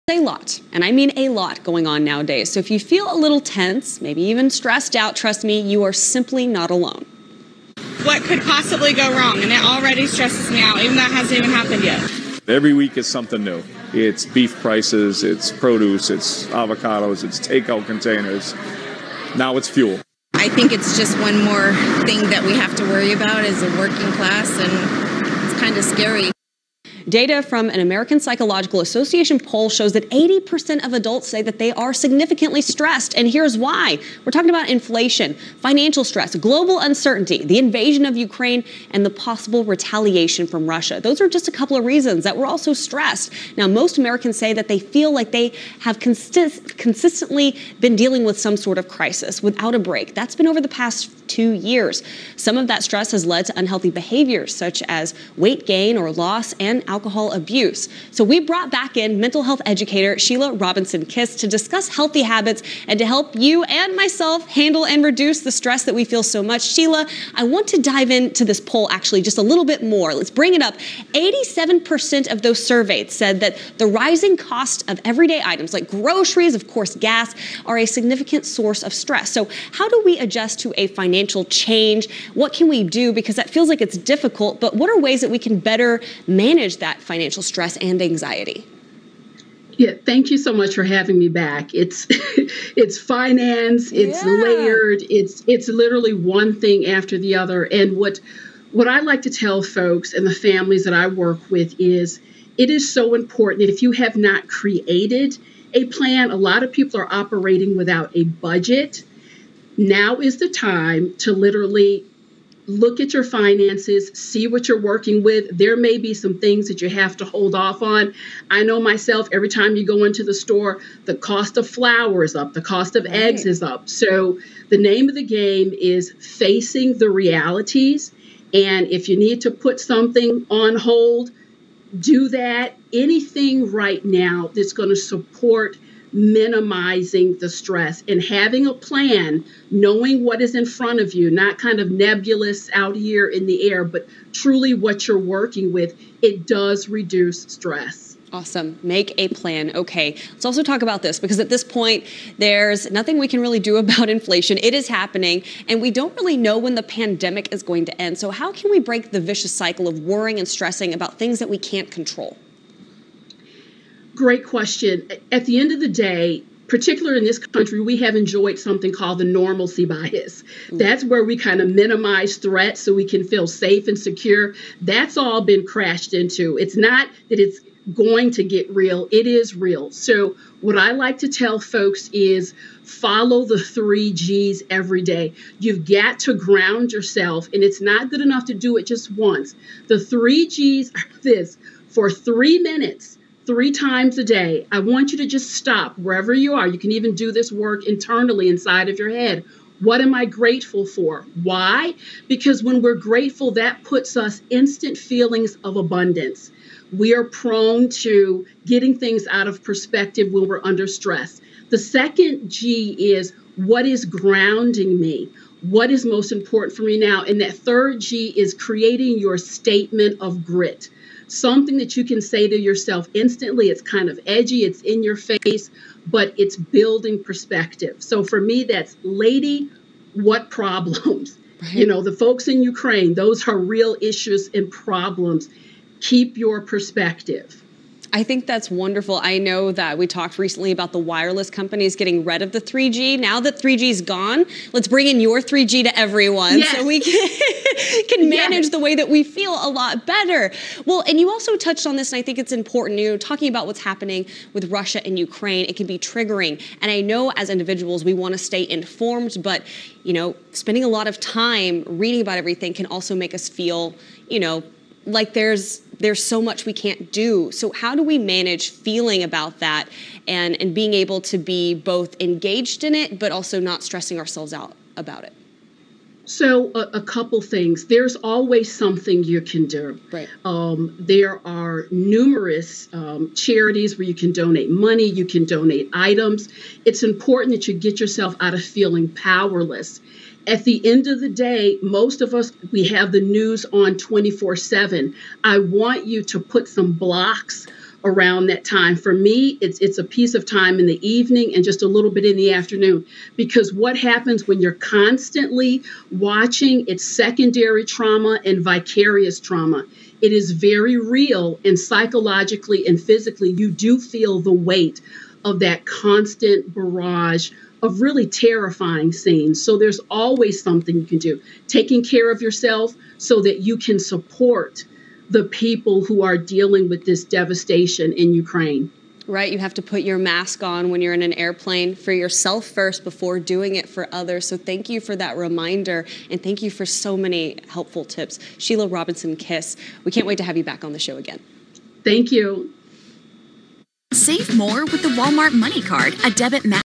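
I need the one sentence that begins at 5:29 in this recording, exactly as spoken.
Right, you have to put your mask on when you're in an airplane for yourself first before doing it for others.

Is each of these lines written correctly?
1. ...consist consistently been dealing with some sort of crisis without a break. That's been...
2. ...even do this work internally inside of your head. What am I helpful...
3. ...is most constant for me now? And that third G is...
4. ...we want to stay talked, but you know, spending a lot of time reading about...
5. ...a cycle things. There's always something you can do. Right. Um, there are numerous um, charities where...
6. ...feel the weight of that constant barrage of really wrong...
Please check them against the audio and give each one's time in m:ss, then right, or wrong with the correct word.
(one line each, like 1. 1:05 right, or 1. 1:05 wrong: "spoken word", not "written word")
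1. 0:45 right
2. 3:16 wrong: "grateful", not "helpful"
3. 3:35 wrong: "important", not "constant"
4. 4:18 wrong: "informed", not "talked"
5. 4:36 wrong: "couple", not "cycle"
6. 5:13 wrong: "terrifying", not "wrong".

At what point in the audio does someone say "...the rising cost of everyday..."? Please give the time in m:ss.
1:13.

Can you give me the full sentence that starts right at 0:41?
Those are just a couple of reasons that we're also stressed.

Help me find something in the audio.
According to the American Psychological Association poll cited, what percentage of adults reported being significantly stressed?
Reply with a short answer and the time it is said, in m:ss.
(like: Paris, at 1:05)
80%, at 0:30.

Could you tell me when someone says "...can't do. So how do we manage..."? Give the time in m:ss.
4:26.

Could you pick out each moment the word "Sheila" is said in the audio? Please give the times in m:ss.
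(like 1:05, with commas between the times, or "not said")
1:00, 1:06, 5:38.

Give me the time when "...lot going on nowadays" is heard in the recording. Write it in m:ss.
0:01.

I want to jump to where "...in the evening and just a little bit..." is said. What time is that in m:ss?
5:00.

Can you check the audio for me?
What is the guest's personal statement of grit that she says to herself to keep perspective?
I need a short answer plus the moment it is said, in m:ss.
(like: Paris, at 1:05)
Lady, what problems?, at 3:49.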